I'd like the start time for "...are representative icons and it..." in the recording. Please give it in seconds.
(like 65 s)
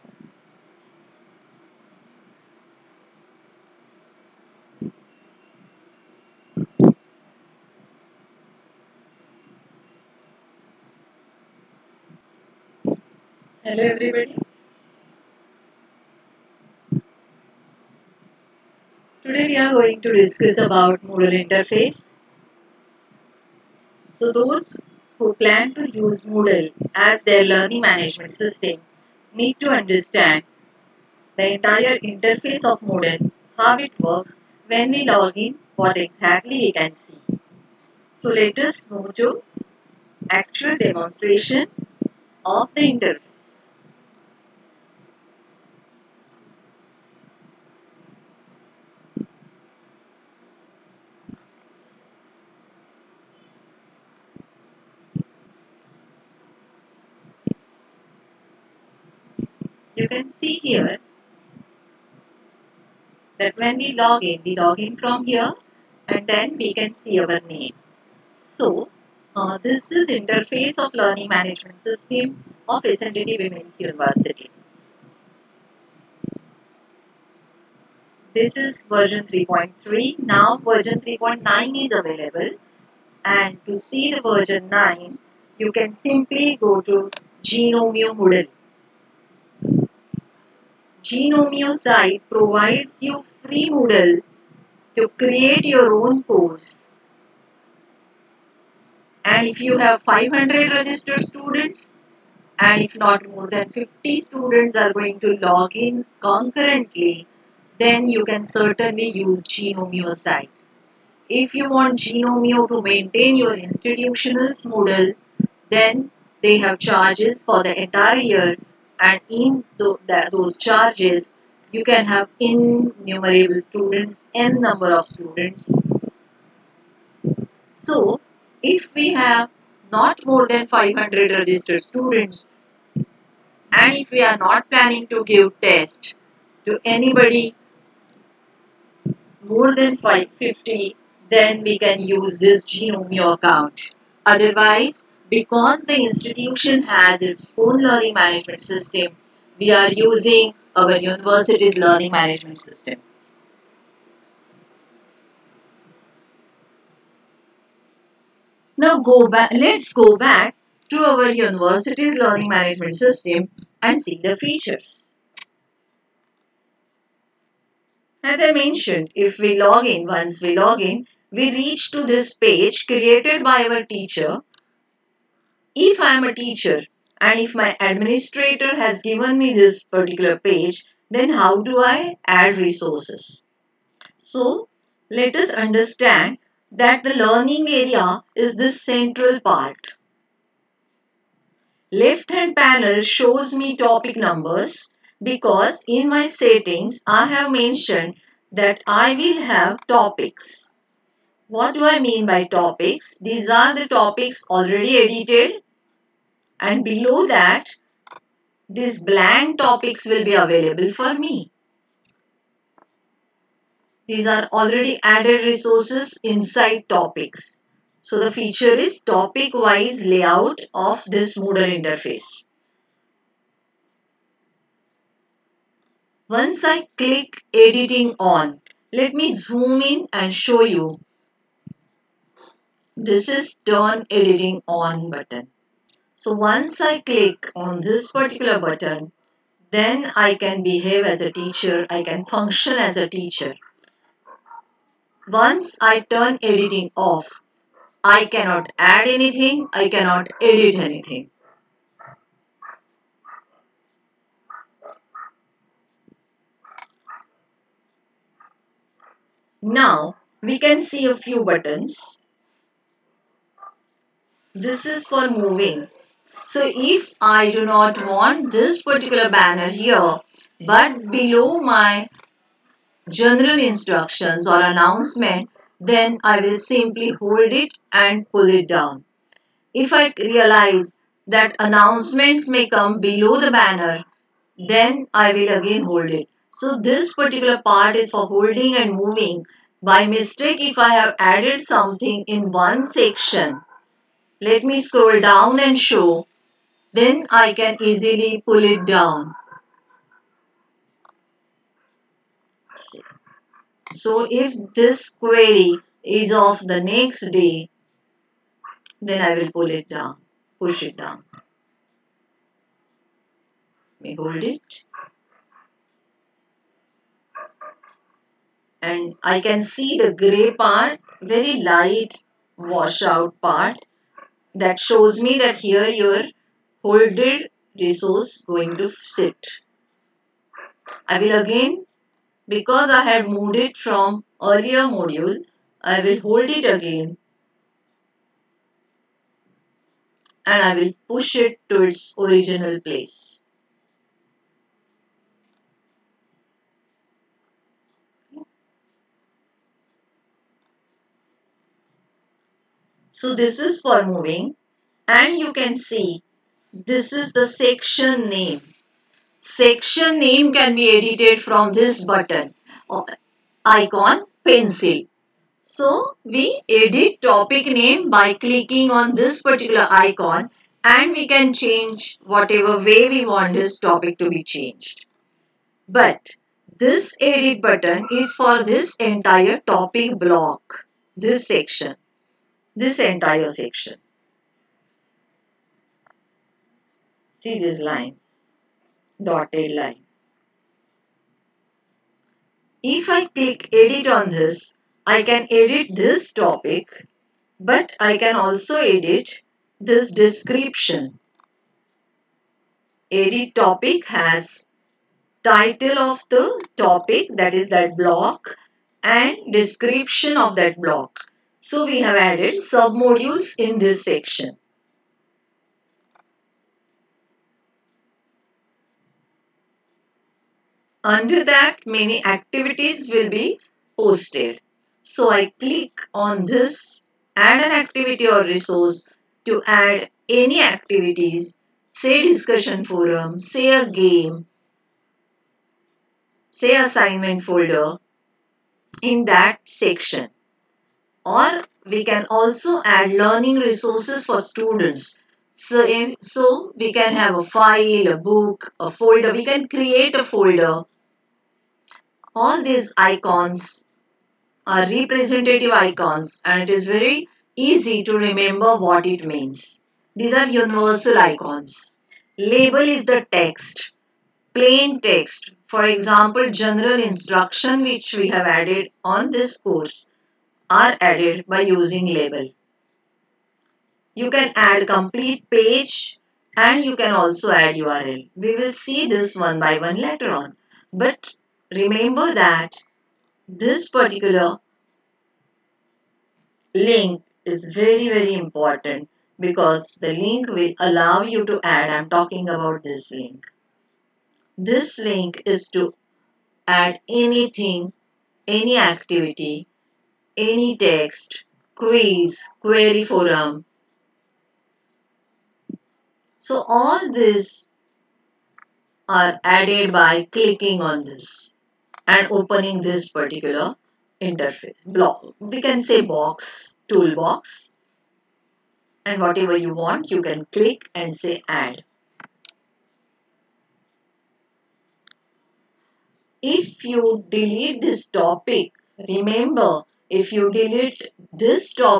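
454 s.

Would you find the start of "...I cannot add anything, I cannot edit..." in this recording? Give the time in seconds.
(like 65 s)
248 s.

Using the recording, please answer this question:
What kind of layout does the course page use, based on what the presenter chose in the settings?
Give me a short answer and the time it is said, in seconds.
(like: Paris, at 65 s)
Topic wise layout, at 219 s.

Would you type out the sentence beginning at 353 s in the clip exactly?
So this is for moving and you can see this is the section name.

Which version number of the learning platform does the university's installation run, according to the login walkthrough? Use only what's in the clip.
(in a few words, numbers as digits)
3.3.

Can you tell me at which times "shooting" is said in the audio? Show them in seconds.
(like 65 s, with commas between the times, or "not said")
not said.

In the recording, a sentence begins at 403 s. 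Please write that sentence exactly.
Edit topic has title of the topic that is that block and description of that block.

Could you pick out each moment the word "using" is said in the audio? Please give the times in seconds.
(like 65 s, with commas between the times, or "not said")
149 s, 471 s.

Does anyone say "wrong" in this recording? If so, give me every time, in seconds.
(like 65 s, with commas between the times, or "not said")
not said.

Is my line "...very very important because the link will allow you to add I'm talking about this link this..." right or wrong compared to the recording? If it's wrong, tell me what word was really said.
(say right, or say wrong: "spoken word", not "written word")
right.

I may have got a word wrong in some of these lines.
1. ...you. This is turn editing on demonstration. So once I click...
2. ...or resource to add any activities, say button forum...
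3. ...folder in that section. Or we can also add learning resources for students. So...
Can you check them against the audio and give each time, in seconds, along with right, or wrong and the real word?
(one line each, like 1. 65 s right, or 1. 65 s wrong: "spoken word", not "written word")
1. 230 s wrong: "button", not "demonstration"
2. 428 s wrong: "discussion", not "button"
3. 437 s right.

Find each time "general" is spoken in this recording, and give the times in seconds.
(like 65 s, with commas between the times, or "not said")
273 s, 466 s.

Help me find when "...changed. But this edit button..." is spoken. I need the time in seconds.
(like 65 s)
374 s.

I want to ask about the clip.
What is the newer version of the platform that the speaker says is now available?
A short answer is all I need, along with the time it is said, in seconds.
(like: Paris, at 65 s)
3.9, at 80 s.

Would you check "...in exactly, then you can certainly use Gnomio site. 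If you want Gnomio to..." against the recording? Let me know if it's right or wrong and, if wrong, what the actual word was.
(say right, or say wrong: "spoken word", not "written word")
wrong: "concurrently", not "exactly".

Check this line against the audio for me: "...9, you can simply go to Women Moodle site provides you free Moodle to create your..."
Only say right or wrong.
wrong.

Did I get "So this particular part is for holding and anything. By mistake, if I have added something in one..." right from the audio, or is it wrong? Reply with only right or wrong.
wrong.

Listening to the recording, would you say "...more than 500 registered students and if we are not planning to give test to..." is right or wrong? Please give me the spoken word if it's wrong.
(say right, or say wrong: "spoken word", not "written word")
right.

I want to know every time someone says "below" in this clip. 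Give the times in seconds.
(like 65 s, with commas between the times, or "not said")
206 s, 271 s, 283 s.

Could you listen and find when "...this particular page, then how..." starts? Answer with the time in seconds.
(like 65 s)
179 s.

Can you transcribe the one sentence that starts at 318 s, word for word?
And I can see the gray part, very light washout part that shows me that here your holded resource going to sit.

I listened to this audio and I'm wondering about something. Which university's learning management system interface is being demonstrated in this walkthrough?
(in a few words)
SNDT Women's University.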